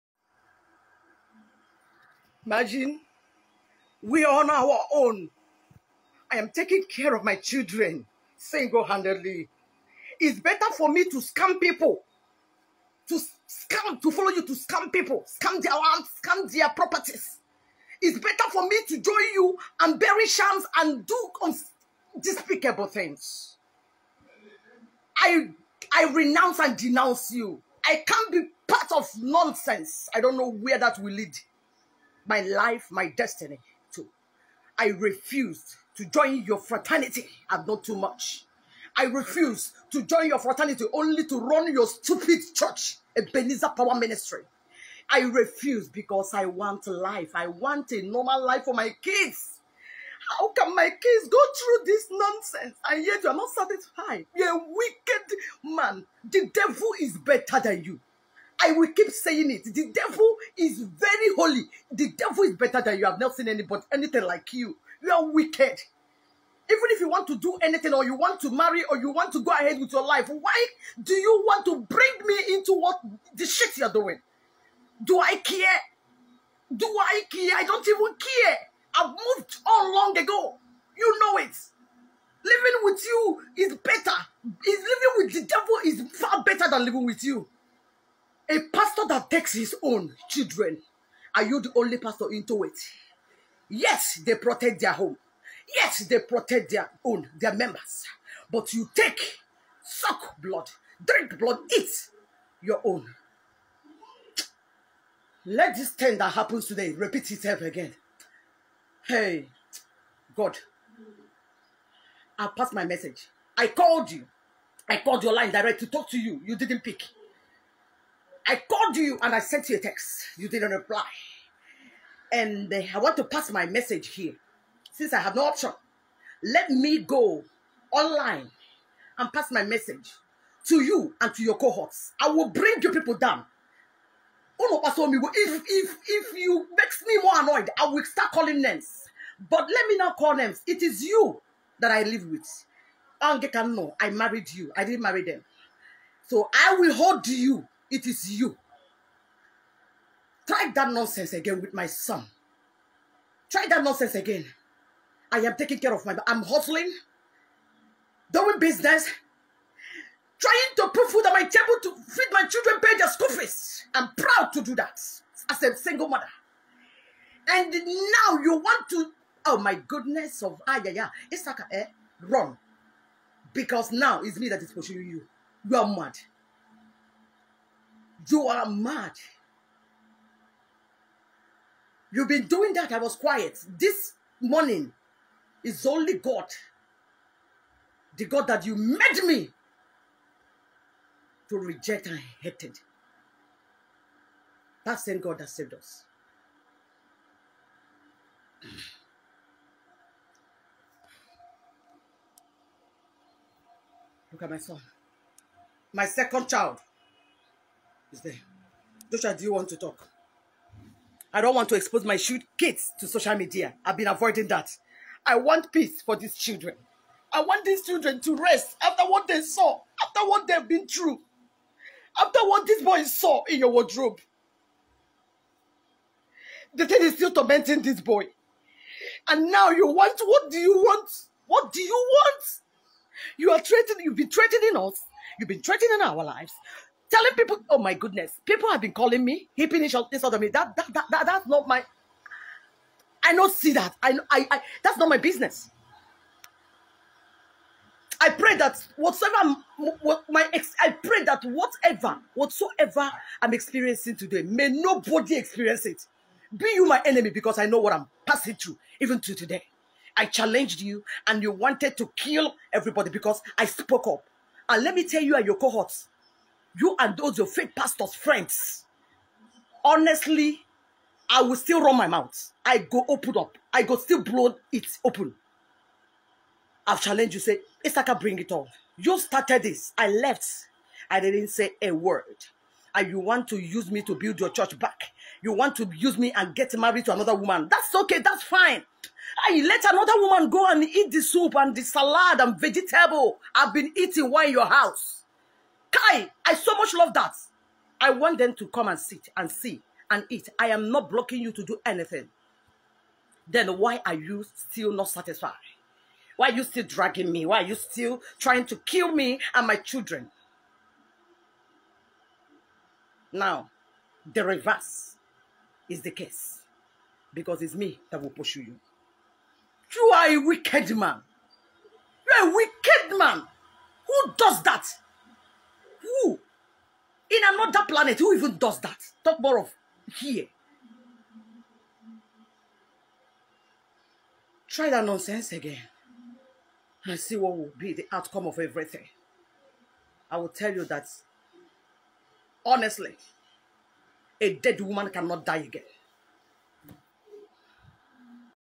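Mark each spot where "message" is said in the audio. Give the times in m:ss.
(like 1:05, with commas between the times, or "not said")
1:52, 2:03, 2:09.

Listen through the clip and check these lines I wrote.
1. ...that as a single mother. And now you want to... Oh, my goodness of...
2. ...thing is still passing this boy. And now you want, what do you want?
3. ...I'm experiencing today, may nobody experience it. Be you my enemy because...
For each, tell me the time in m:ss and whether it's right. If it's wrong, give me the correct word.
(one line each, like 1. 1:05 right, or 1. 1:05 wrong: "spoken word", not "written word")
1. 2:44 right
2. 3:46 wrong: "tormenting", not "passing"
3. 4:13 right.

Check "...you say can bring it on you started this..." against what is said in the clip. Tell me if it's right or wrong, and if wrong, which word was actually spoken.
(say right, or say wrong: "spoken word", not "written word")
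right.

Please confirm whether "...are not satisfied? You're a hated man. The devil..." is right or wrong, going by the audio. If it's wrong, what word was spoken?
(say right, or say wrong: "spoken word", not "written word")
wrong: "wicked", not "hated".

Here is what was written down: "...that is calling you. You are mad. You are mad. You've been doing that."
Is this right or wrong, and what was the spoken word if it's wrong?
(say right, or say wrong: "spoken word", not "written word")
wrong: "pushing", not "calling".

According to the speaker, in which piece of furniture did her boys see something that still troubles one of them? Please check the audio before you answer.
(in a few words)
Wardrobe.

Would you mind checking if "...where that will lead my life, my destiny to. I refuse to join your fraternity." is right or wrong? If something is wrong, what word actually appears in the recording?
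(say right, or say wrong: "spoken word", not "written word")
right.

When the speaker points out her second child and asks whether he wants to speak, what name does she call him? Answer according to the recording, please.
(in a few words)
Joshua.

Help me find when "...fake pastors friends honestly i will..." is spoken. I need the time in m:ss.
4:27.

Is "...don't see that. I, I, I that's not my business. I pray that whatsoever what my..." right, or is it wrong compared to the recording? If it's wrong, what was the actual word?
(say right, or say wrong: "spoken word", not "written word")
right.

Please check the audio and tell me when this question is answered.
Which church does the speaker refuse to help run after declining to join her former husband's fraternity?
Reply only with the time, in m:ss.
0:43.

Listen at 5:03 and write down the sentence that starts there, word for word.
Then why are you still not satisfied?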